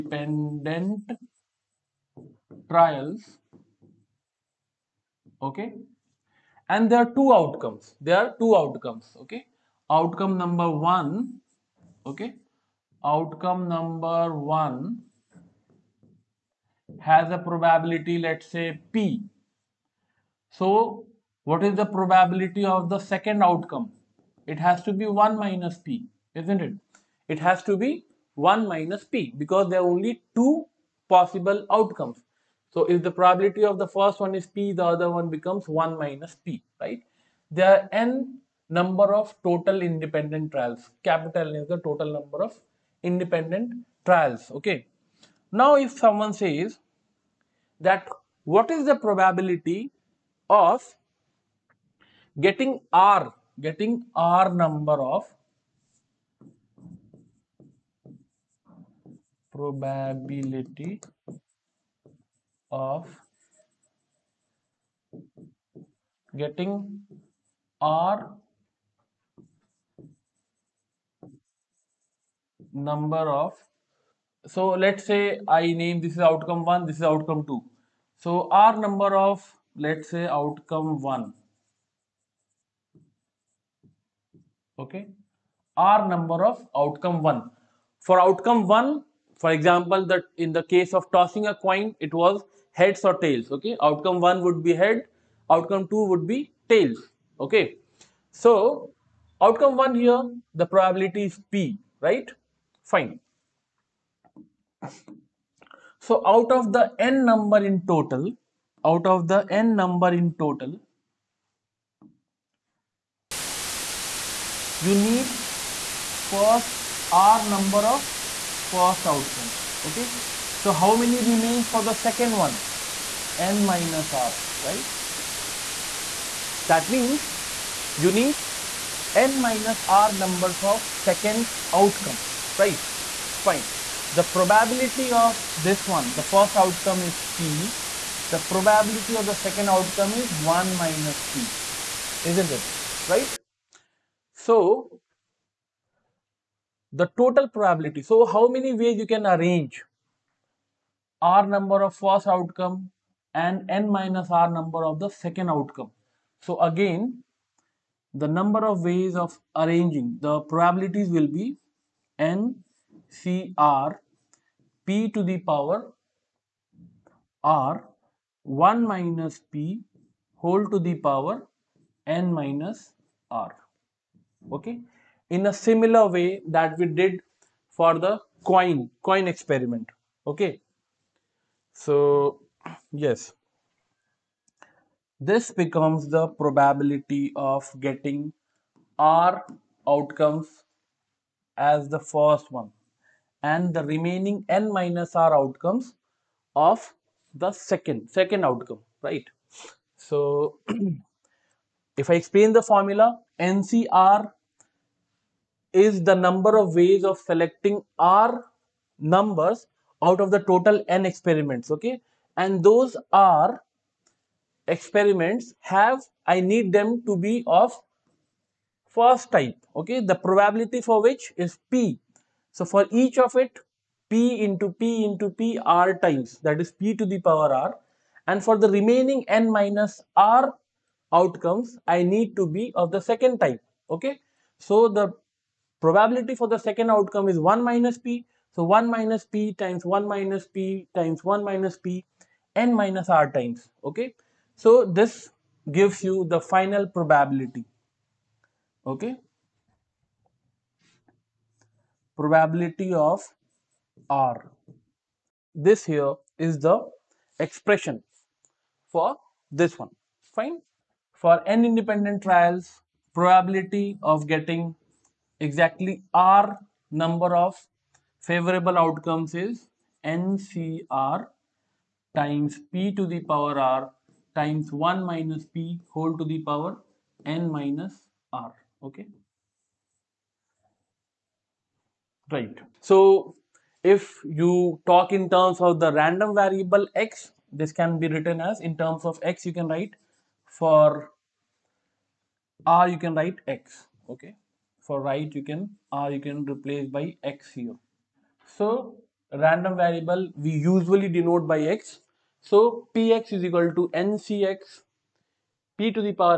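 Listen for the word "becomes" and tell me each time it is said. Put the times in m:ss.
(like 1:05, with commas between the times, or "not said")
0:35, 3:05.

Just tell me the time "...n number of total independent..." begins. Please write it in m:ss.
0:37.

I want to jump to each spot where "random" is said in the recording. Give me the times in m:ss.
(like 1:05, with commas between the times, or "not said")
4:46, 4:59.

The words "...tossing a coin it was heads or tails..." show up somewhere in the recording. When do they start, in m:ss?
1:31.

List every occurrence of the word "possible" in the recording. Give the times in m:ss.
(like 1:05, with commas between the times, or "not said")
0:31.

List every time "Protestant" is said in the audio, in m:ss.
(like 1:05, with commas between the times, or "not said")
not said.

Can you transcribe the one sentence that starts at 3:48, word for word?
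And for the remaining N minus R outcomes, I need to be of the second type, okay?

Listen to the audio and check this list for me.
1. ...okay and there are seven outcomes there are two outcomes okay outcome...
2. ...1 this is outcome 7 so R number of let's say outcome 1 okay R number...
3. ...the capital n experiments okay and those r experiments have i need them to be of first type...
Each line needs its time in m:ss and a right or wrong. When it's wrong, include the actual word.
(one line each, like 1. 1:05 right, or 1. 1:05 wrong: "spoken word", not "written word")
1. 0:05 wrong: "two", not "seven"
2. 1:16 wrong: "2", not "7"
3. 3:30 wrong: "total", not "capital".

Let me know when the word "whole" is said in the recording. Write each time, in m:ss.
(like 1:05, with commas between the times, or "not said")
2:50, 4:35.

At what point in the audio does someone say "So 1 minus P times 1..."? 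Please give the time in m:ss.
3:58.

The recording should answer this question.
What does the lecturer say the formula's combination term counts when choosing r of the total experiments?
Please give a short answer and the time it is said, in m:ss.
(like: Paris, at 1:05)
number of ways of selecting, at 3:26.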